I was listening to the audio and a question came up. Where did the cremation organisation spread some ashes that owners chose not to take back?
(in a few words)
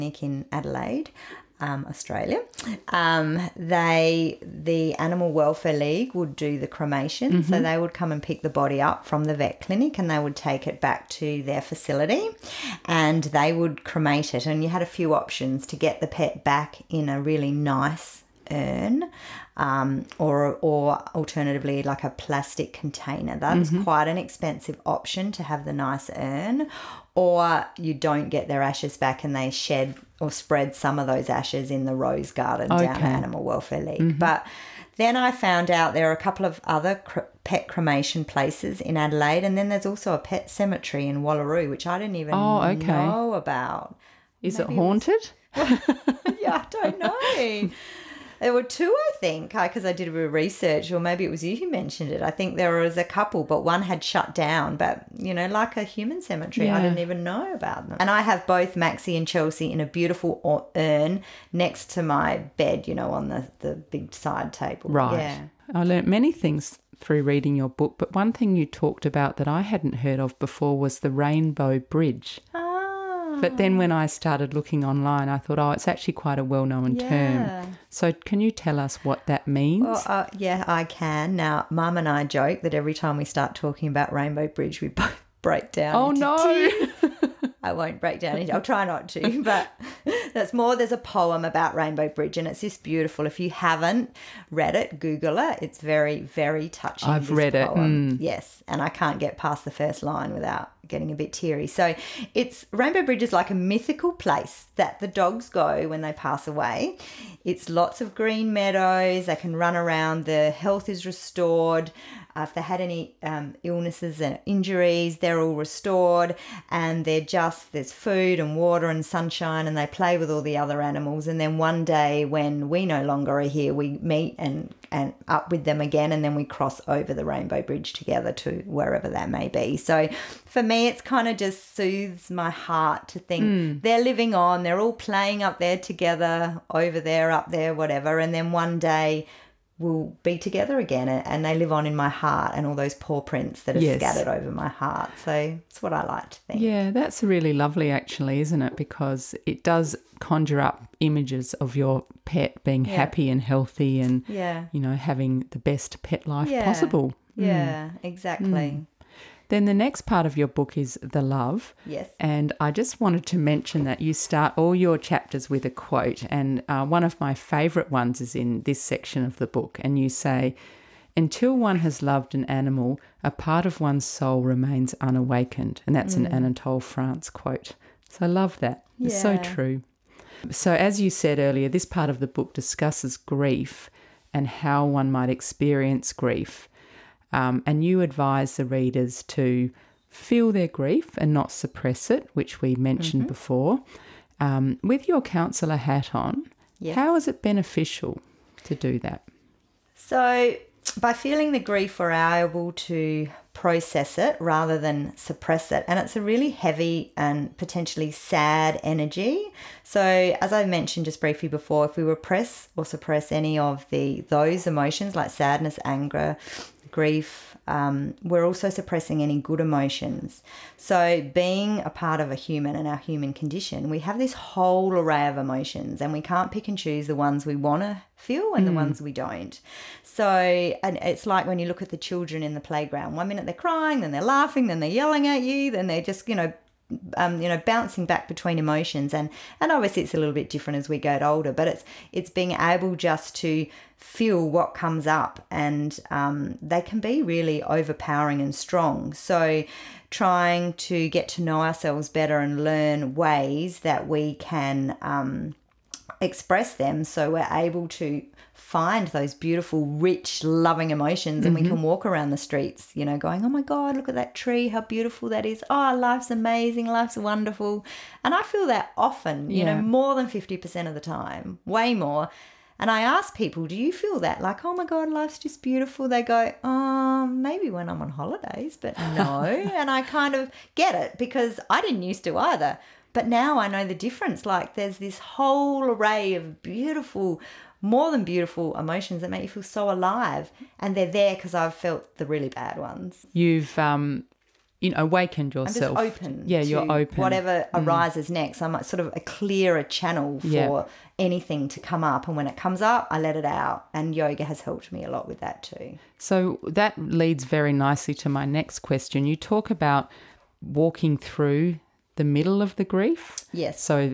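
the rose garden.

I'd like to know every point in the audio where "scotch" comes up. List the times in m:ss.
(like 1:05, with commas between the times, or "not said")
not said.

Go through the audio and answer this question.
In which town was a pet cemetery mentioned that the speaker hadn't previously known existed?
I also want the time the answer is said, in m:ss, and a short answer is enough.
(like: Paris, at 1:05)
Wallaroo, at 0:41.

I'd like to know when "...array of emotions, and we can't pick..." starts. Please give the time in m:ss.
3:44.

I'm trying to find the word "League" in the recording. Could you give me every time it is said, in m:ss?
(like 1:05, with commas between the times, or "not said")
0:05, 0:33.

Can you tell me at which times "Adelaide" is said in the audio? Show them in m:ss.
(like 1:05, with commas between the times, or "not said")
0:00, 0:38.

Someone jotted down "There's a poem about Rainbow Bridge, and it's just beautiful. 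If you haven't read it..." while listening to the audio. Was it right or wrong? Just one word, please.
right.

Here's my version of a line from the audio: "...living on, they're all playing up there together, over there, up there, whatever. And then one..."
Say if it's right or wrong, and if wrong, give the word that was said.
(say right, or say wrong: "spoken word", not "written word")
right.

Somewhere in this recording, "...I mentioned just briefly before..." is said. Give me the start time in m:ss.
3:30.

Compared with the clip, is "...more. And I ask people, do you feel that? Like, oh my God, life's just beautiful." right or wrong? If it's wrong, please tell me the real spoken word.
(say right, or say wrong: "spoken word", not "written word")
right.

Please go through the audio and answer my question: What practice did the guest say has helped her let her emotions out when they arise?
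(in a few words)
yoga.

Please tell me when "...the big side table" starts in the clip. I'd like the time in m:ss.
1:03.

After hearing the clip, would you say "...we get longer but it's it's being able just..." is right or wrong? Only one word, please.
wrong.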